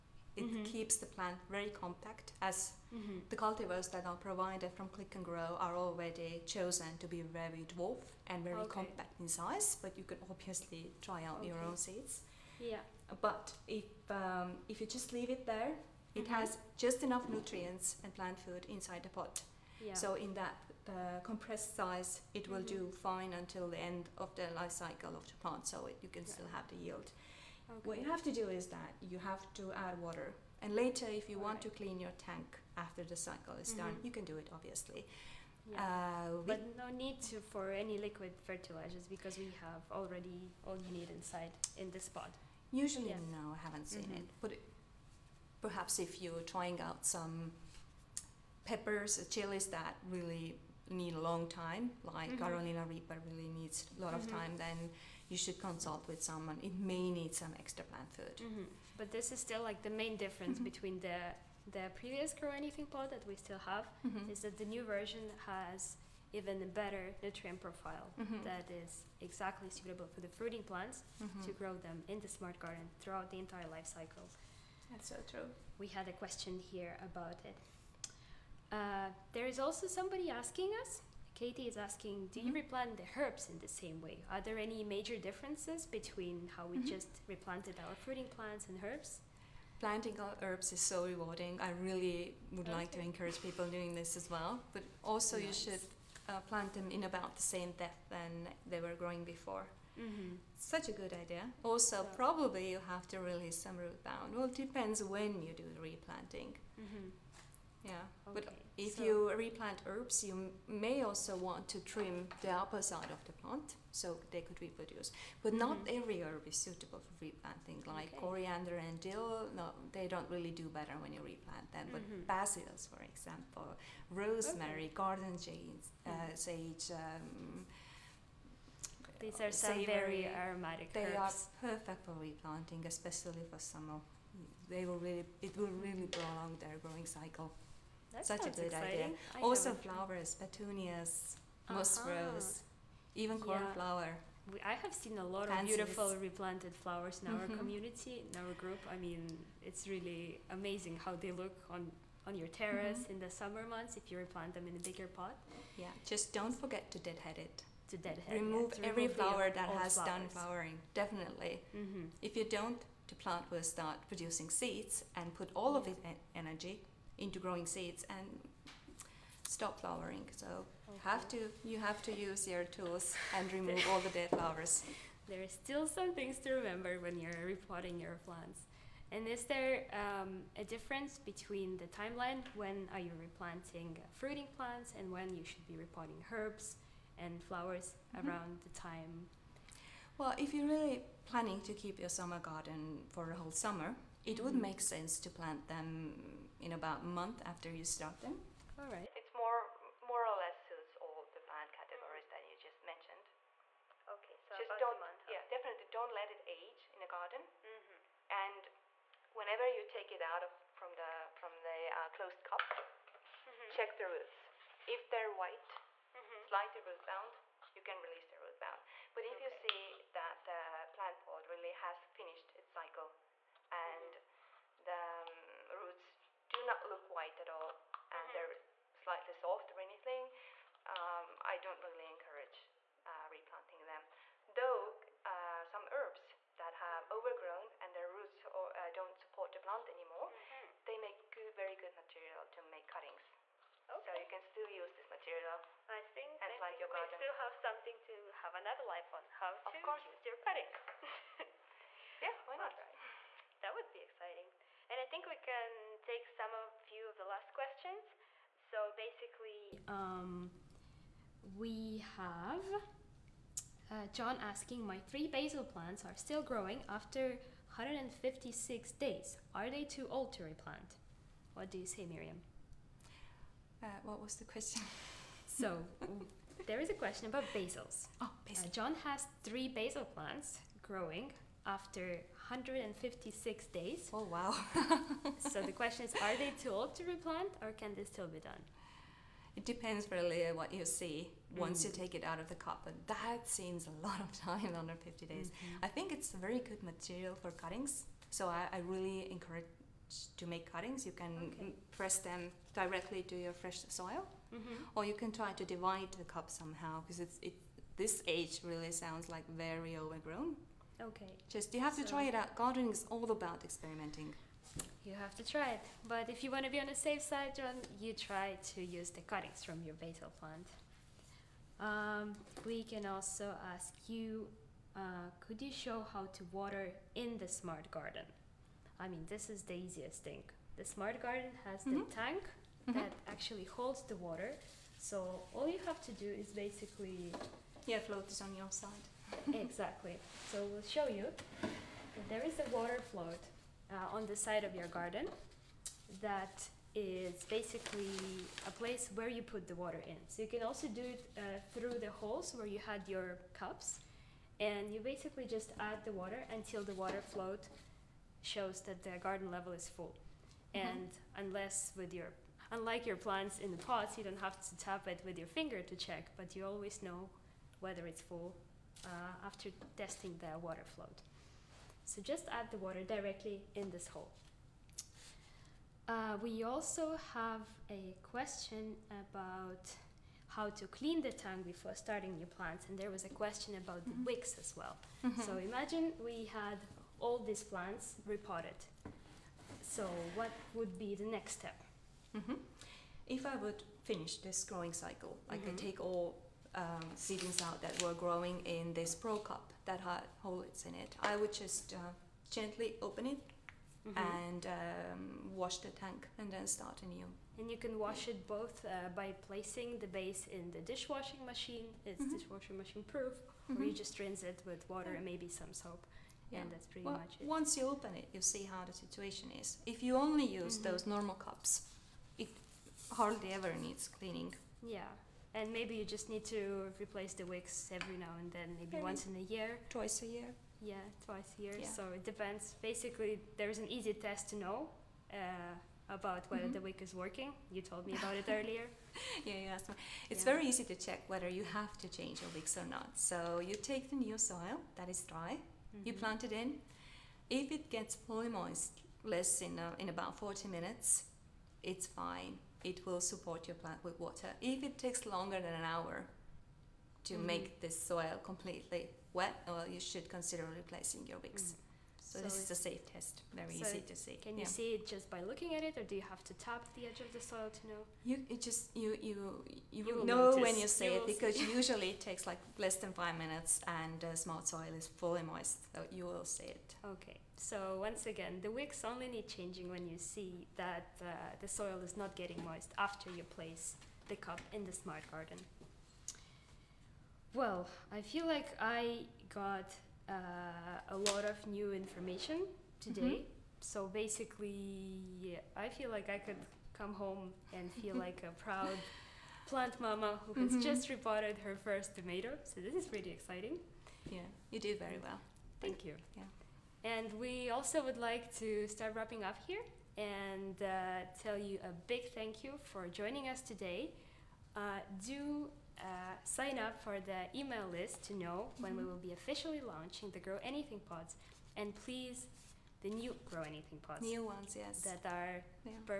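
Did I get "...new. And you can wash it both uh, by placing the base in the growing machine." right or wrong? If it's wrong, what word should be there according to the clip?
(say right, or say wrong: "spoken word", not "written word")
wrong: "dishwashing", not "growing".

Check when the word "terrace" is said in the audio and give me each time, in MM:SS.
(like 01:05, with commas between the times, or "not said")
02:32.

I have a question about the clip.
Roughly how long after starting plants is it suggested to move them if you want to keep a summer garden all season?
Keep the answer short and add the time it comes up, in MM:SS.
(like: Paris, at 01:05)
About a month, at 03:16.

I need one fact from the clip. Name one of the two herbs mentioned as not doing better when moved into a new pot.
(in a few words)
Coriander.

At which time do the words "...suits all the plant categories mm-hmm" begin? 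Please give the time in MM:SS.
03:20.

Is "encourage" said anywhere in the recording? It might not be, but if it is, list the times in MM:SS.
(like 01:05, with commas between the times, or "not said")
01:33, 03:52, 04:59.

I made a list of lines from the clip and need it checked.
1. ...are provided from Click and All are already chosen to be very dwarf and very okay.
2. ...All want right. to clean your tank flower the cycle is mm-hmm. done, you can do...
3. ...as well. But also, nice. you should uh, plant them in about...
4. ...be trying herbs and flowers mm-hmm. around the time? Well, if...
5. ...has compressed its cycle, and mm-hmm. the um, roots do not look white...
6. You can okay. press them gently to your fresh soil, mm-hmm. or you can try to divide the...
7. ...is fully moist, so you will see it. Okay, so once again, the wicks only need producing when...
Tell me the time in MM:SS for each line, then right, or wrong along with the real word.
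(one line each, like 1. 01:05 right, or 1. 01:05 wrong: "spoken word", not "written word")
1. 00:04 wrong: "Grow", not "All"
2. 00:31 wrong: "after", not "flower"
3. 01:34 right
4. 03:05 wrong: "repotting", not "trying"
5. 03:41 wrong: "finished", not "compressed"
6. 05:01 wrong: "directly", not "gently"
7. 07:54 wrong: "changing", not "producing".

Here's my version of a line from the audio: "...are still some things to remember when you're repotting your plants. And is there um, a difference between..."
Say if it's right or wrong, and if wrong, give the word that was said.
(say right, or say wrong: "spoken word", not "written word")
right.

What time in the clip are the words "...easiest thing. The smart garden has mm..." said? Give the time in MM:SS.
05:29.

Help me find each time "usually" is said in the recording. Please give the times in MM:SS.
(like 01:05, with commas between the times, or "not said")
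00:42, 07:51.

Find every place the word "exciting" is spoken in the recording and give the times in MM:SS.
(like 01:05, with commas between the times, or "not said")
02:18, 04:14, 08:23.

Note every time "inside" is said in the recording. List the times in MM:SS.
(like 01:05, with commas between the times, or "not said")
00:18, 00:41.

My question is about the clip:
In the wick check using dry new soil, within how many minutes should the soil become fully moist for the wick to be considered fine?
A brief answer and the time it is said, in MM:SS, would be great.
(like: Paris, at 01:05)
40, at 07:30.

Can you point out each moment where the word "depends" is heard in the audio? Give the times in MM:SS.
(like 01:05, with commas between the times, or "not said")
01:44, 04:49, 07:12.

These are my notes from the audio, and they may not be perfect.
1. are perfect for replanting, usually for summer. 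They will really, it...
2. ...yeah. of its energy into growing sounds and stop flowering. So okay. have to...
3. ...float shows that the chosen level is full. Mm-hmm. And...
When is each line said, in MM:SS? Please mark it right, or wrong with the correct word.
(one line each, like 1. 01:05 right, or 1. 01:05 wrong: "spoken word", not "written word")
1. 02:11 wrong: "especially", not "usually"
2. 02:45 wrong: "seeds", not "sounds"
3. 05:57 wrong: "garden", not "chosen".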